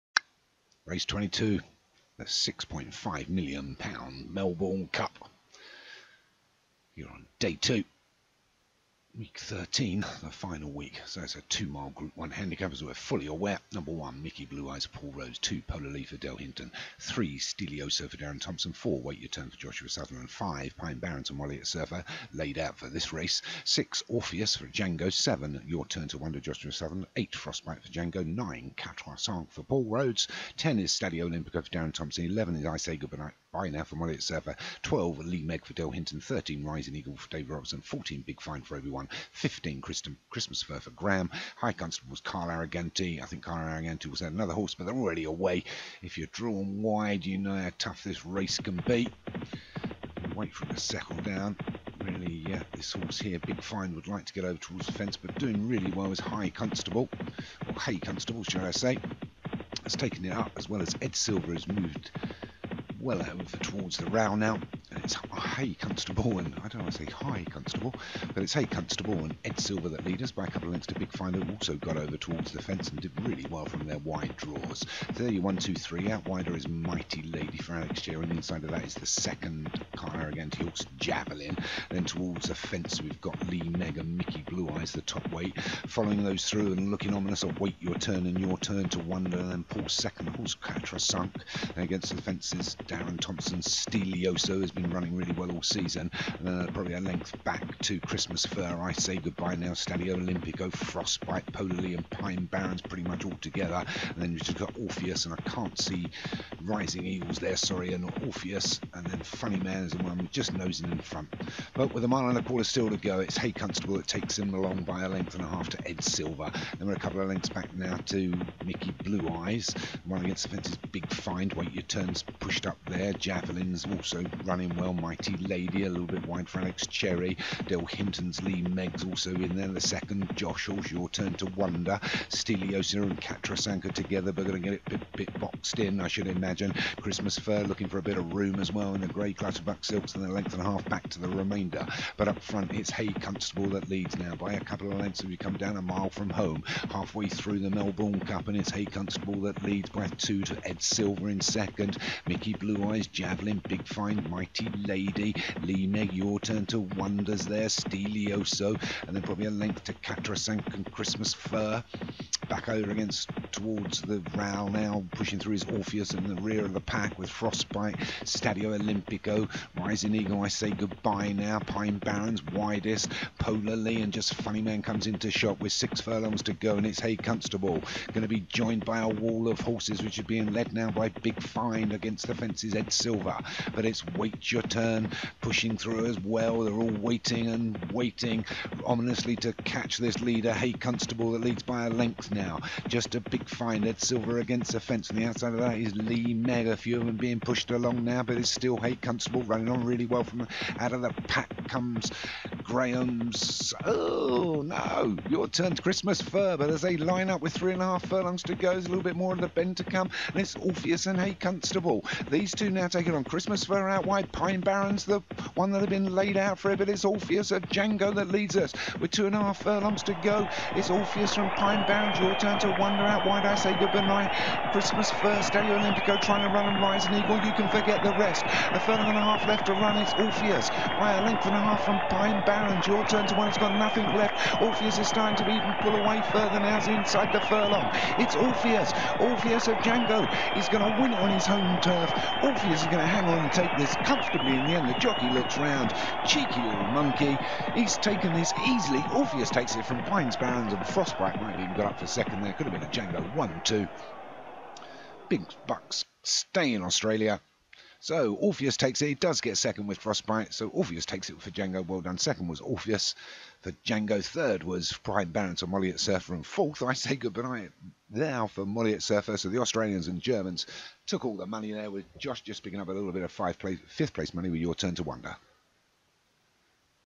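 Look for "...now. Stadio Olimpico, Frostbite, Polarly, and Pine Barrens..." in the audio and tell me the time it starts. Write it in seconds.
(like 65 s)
99 s.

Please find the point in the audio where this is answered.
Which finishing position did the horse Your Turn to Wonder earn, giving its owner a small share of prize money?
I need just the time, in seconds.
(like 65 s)
273 s.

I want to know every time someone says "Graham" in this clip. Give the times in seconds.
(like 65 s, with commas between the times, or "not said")
40 s, 202 s.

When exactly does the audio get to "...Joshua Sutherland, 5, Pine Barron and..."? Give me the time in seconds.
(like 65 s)
19 s.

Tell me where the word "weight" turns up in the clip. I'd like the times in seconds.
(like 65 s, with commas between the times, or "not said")
85 s.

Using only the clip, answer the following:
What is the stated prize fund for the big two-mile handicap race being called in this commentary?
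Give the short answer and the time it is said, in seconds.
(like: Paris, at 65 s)
£6.5 million, at 2 s.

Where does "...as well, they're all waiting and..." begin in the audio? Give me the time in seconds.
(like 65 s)
186 s.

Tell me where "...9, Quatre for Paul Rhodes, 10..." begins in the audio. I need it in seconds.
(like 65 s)
28 s.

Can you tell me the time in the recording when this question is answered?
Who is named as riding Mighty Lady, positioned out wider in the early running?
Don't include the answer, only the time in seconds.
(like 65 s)
77 s.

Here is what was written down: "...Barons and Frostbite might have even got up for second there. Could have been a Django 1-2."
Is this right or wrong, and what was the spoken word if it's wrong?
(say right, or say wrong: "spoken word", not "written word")
right.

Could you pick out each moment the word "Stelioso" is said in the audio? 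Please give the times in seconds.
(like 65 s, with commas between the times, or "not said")
93 s, 157 s.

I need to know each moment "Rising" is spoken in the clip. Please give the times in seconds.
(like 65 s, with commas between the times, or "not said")
36 s, 106 s, 169 s, 226 s.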